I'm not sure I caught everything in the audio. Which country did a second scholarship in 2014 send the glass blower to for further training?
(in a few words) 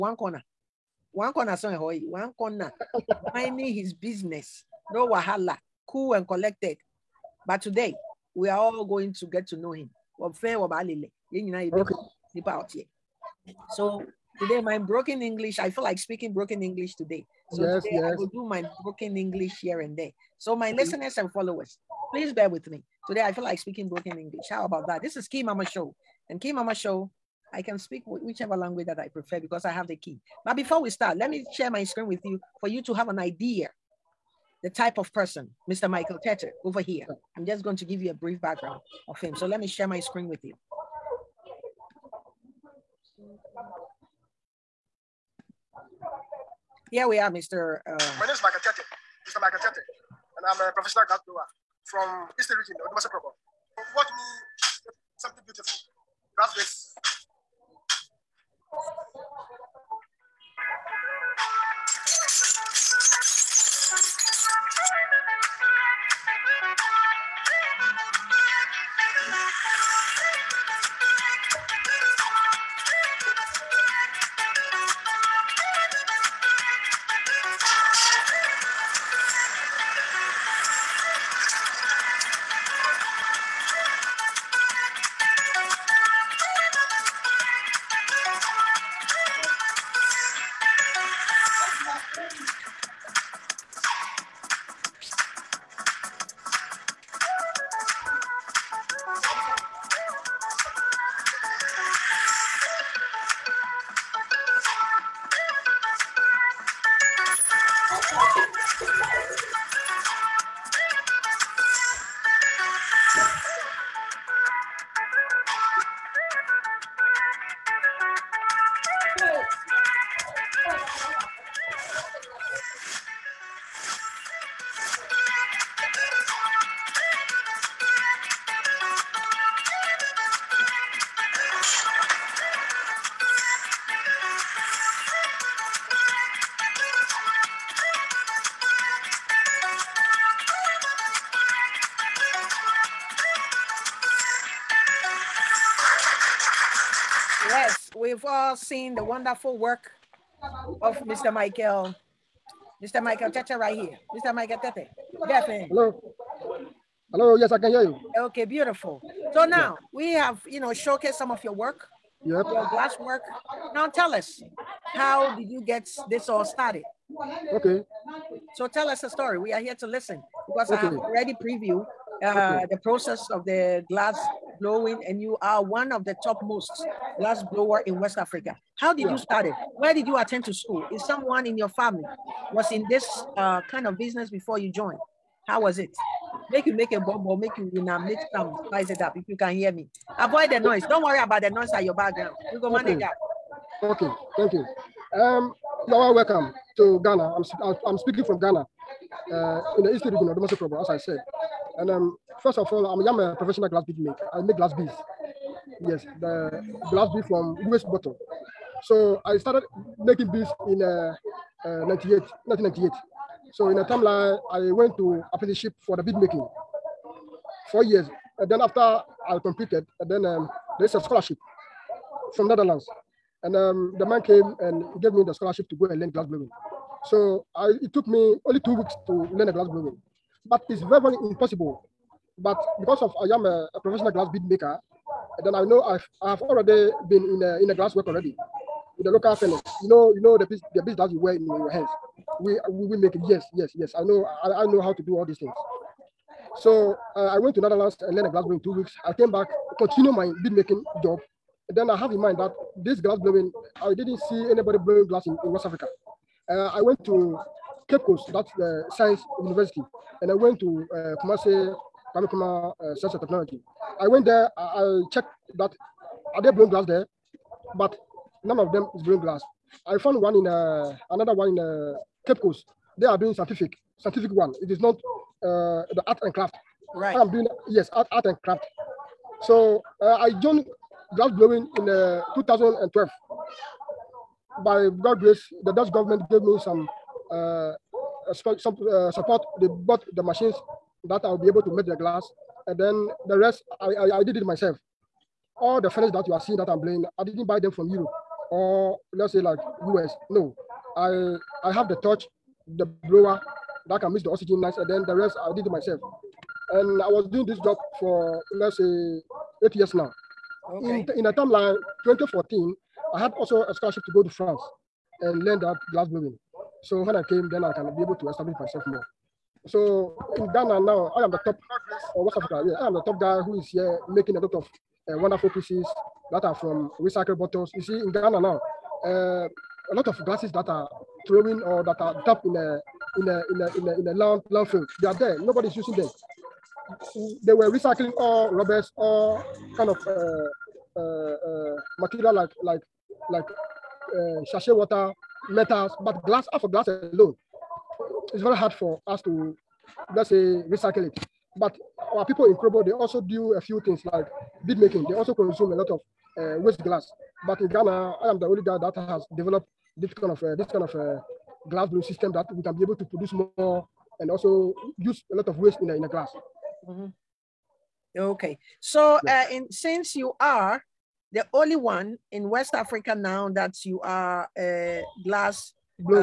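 France.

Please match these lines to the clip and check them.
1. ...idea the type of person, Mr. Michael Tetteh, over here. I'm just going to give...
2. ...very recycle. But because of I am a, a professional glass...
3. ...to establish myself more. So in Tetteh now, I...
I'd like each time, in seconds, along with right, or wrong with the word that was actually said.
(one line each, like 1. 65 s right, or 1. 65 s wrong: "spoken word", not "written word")
1. 33 s right
2. 230 s wrong: "impossible", not "recycle"
3. 318 s wrong: "Ghana", not "Tetteh".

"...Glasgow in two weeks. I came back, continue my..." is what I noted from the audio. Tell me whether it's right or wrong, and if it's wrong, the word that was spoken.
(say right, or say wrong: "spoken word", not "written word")
right.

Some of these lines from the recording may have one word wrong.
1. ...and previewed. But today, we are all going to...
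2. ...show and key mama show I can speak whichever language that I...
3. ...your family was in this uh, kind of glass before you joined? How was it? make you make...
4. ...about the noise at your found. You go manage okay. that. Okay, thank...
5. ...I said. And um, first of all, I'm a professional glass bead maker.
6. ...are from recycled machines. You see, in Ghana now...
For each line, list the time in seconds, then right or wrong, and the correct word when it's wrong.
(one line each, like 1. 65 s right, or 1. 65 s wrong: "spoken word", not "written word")
1. 6 s wrong: "collected", not "previewed"
2. 25 s right
3. 181 s wrong: "business", not "glass"
4. 191 s wrong: "background", not "found"
5. 200 s right
6. 326 s wrong: "bottles", not "machines".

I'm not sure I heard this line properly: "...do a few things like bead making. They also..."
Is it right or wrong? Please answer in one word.
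right.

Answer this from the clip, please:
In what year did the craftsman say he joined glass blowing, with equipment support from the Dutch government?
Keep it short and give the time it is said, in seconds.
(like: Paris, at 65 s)
2012, at 282 s.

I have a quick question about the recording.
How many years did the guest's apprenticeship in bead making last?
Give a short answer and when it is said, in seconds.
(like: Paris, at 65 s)
4 years, at 217 s.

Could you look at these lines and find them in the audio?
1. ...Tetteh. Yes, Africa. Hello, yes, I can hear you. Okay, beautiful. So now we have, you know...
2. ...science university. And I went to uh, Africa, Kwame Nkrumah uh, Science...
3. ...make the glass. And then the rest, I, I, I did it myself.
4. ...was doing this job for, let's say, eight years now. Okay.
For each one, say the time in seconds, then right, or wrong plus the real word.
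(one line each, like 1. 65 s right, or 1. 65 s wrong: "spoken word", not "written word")
1. 154 s wrong: "Hello", not "Africa"
2. 258 s wrong: "Kumasi", not "Africa"
3. 291 s right
4. 307 s right.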